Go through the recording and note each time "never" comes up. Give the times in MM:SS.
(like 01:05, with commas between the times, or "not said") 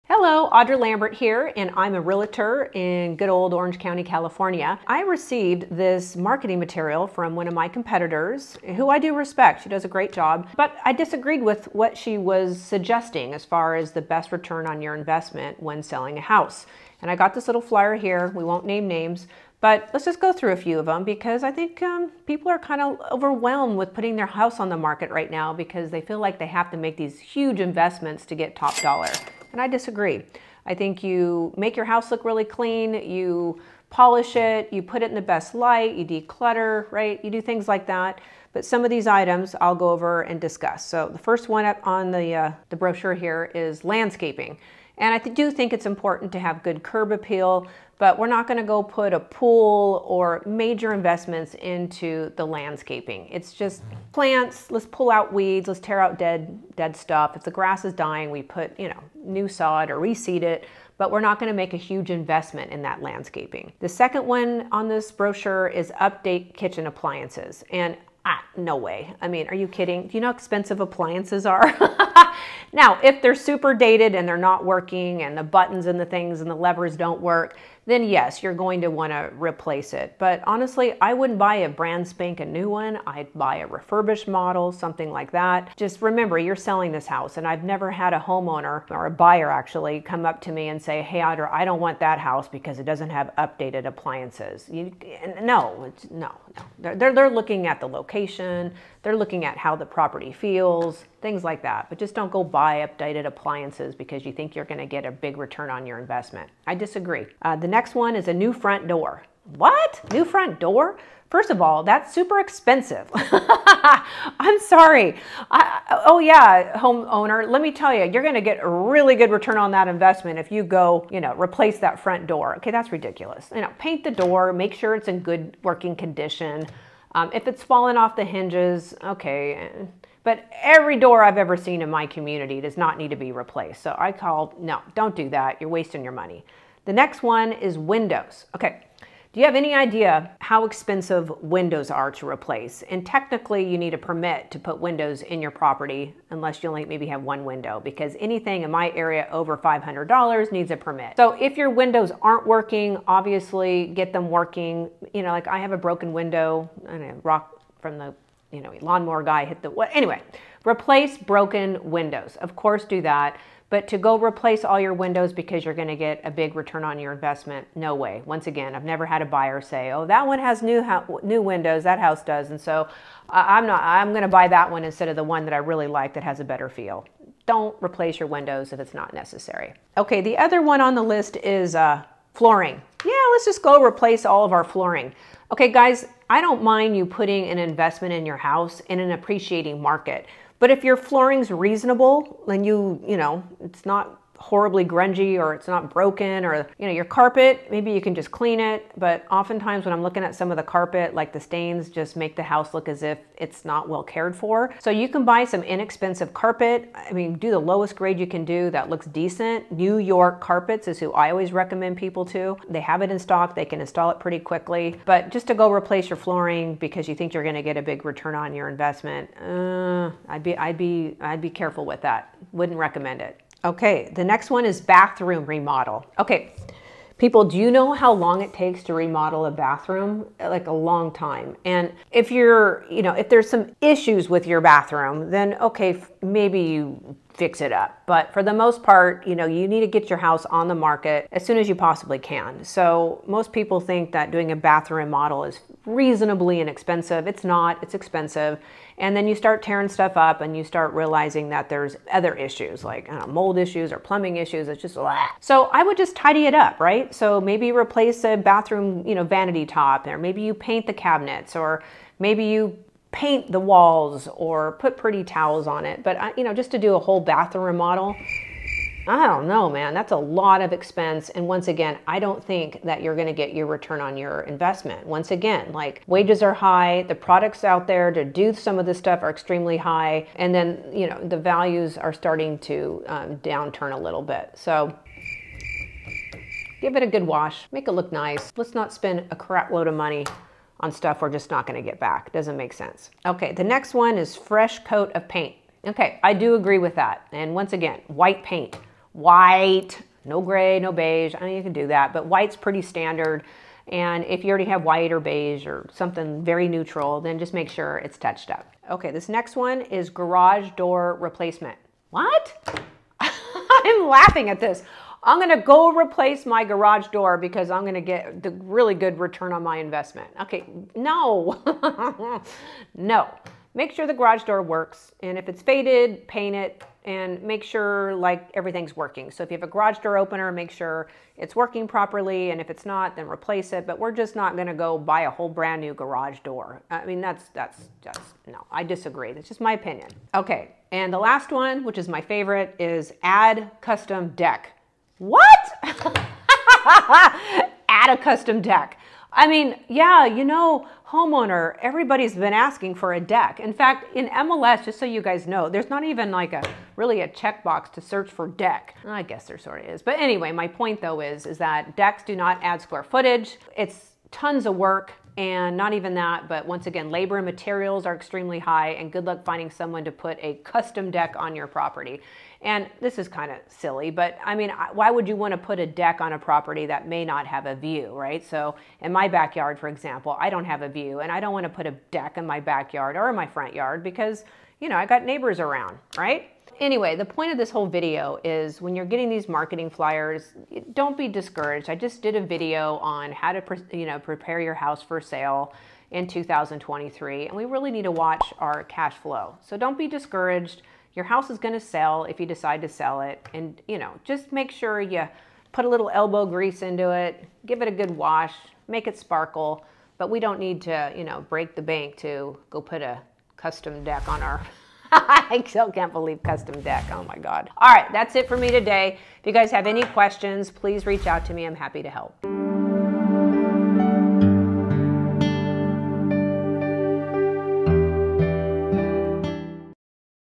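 01:27, 02:48.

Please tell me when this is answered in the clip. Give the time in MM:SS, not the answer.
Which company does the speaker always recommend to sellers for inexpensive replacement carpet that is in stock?
03:29.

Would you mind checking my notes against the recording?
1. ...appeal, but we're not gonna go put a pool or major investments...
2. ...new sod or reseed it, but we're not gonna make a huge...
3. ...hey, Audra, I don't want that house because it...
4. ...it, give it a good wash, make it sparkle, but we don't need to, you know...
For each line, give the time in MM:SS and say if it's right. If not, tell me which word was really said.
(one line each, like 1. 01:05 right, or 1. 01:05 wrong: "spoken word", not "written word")
1. 00:47 right
2. 00:59 right
3. 01:31 right
4. 06:47 right.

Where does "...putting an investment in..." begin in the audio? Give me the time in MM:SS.
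03:07.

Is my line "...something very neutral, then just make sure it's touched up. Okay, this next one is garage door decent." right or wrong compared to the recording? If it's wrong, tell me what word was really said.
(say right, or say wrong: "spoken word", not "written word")
wrong: "replacement", not "decent".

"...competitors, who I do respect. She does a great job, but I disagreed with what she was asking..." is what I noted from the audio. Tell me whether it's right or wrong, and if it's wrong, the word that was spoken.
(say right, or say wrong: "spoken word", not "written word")
wrong: "suggesting", not "asking".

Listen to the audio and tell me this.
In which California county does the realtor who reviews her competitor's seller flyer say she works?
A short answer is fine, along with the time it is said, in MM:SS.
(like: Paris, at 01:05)
Orange County, at 00:03.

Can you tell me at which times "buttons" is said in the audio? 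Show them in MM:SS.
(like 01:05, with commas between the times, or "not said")
01:15.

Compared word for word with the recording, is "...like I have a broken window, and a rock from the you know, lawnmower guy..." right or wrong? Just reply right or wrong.
right.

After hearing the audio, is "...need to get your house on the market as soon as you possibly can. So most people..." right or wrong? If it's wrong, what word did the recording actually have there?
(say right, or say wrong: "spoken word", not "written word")
right.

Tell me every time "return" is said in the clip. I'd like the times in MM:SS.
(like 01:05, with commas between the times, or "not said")
00:14, 01:45, 01:59, 02:46, 03:38, 04:33, 05:19.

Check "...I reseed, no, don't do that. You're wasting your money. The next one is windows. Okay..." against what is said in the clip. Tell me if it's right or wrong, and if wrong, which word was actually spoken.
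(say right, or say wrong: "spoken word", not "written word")
wrong: "called", not "reseed".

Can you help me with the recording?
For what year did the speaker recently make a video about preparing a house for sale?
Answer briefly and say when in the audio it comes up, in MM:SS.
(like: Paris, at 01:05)
2023, at 06:36.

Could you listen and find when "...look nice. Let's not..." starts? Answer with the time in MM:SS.
04:47.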